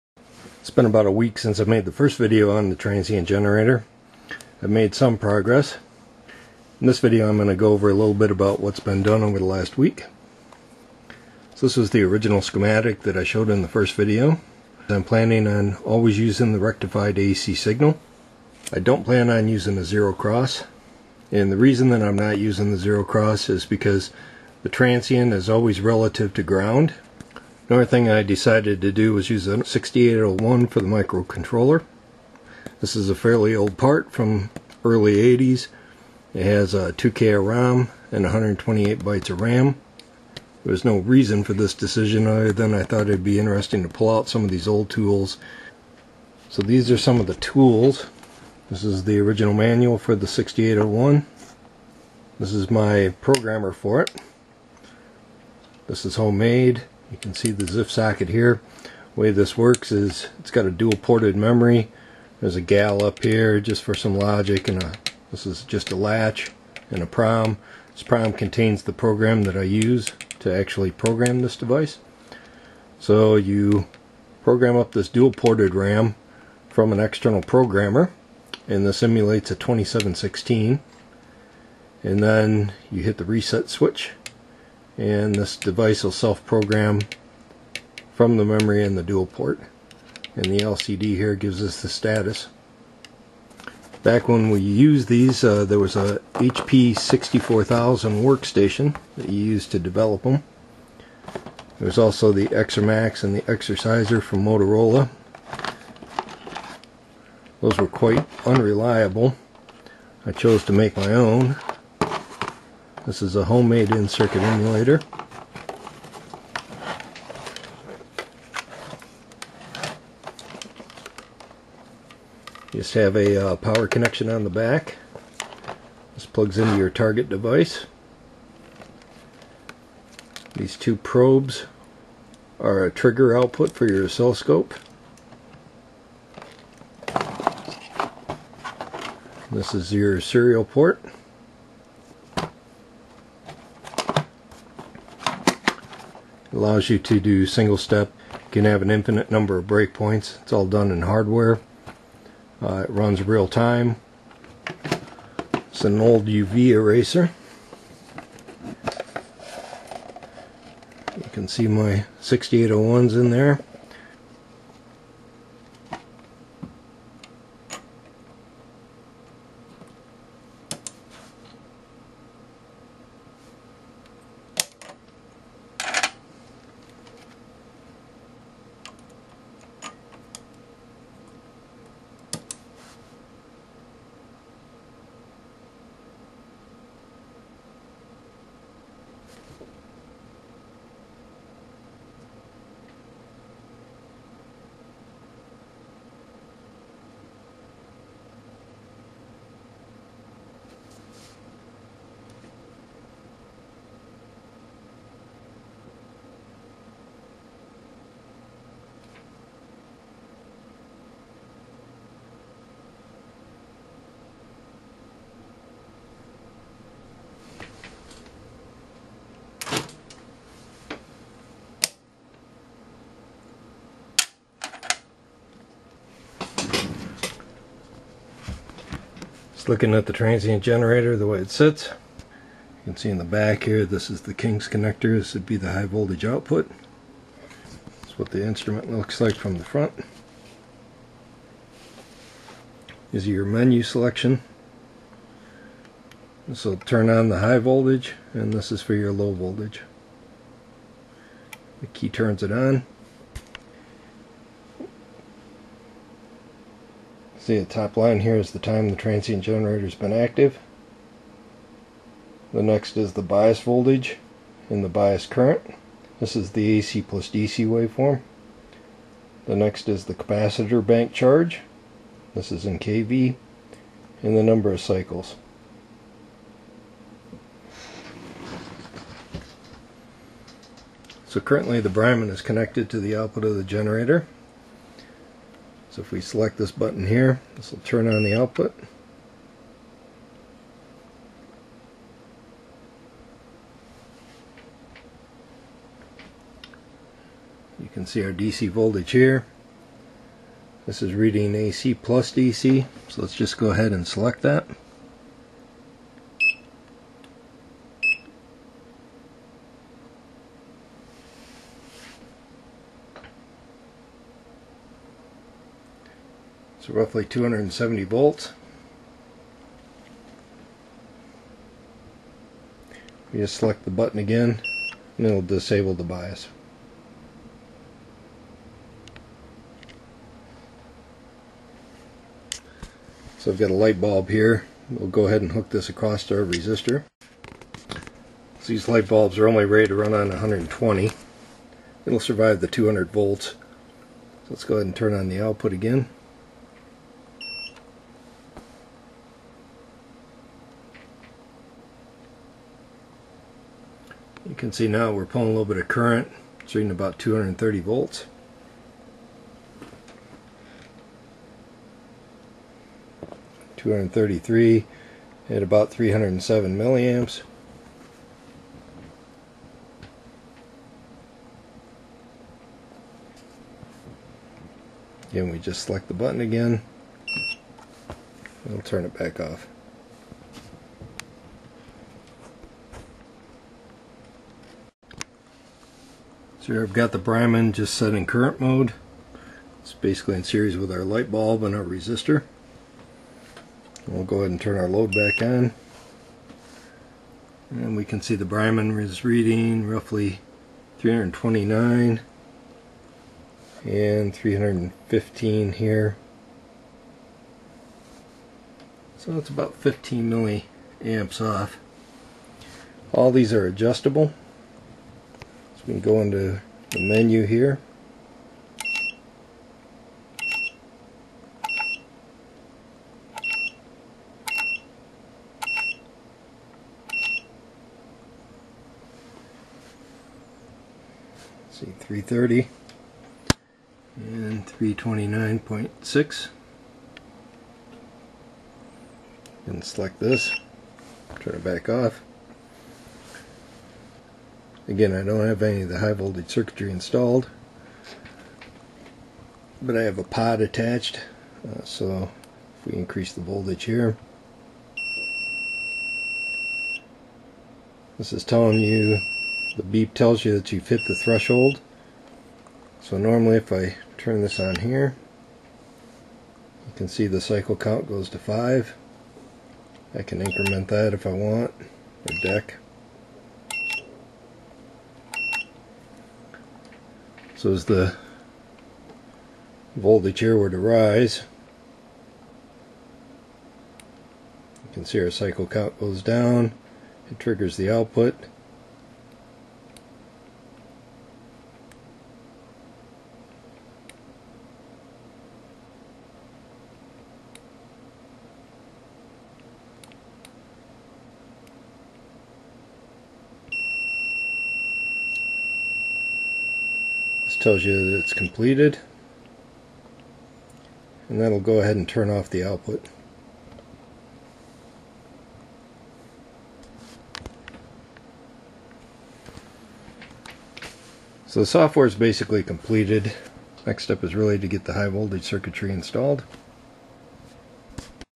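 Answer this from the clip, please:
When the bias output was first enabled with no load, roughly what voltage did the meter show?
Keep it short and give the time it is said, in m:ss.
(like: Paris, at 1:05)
270 volts, at 5:17.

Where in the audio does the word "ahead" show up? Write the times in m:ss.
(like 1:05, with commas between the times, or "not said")
5:03, 5:35, 5:44, 6:34, 8:31.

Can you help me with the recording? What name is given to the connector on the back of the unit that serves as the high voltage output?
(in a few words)
King's connector.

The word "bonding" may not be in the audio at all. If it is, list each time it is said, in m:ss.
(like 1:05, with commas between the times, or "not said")
not said.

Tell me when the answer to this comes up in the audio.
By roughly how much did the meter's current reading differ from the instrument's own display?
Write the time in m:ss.
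6:49.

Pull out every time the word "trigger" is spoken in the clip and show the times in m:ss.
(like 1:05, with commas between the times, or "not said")
2:12, 8:07.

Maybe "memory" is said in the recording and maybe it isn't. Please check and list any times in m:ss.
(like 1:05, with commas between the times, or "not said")
1:01, 1:28.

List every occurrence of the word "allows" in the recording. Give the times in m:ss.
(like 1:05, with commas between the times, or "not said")
2:26.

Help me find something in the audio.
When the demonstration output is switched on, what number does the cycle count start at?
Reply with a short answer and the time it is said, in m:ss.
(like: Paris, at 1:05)
5, at 7:48.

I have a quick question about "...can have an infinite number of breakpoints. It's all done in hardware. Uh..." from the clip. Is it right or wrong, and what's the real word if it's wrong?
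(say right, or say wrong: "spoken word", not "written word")
right.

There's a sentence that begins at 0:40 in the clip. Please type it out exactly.
There was no reason for this decision other than I thought it'd be interesting to pull out some of these old tools.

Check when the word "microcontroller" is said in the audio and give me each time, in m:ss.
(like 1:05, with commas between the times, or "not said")
0:30.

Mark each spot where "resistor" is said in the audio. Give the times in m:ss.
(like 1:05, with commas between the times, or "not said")
5:36, 6:31.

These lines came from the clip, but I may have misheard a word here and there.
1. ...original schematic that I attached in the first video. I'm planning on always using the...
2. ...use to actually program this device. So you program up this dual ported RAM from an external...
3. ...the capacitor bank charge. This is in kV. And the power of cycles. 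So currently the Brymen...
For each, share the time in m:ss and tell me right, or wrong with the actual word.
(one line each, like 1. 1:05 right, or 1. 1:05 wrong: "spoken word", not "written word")
1. 0:12 wrong: "showed", not "attached"
2. 1:09 right
3. 4:30 wrong: "number", not "power".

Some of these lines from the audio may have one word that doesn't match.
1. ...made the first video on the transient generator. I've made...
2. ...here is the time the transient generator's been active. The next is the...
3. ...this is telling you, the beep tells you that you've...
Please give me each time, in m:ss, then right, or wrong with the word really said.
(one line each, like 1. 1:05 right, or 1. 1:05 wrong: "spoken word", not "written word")
1. 0:01 right
2. 4:18 right
3. 7:38 right.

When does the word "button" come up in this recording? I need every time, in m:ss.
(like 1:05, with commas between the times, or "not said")
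4:46, 5:23, 6:16.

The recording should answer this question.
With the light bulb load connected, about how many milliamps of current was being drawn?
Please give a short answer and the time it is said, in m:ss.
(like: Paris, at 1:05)
307 milliamps, at 6:05.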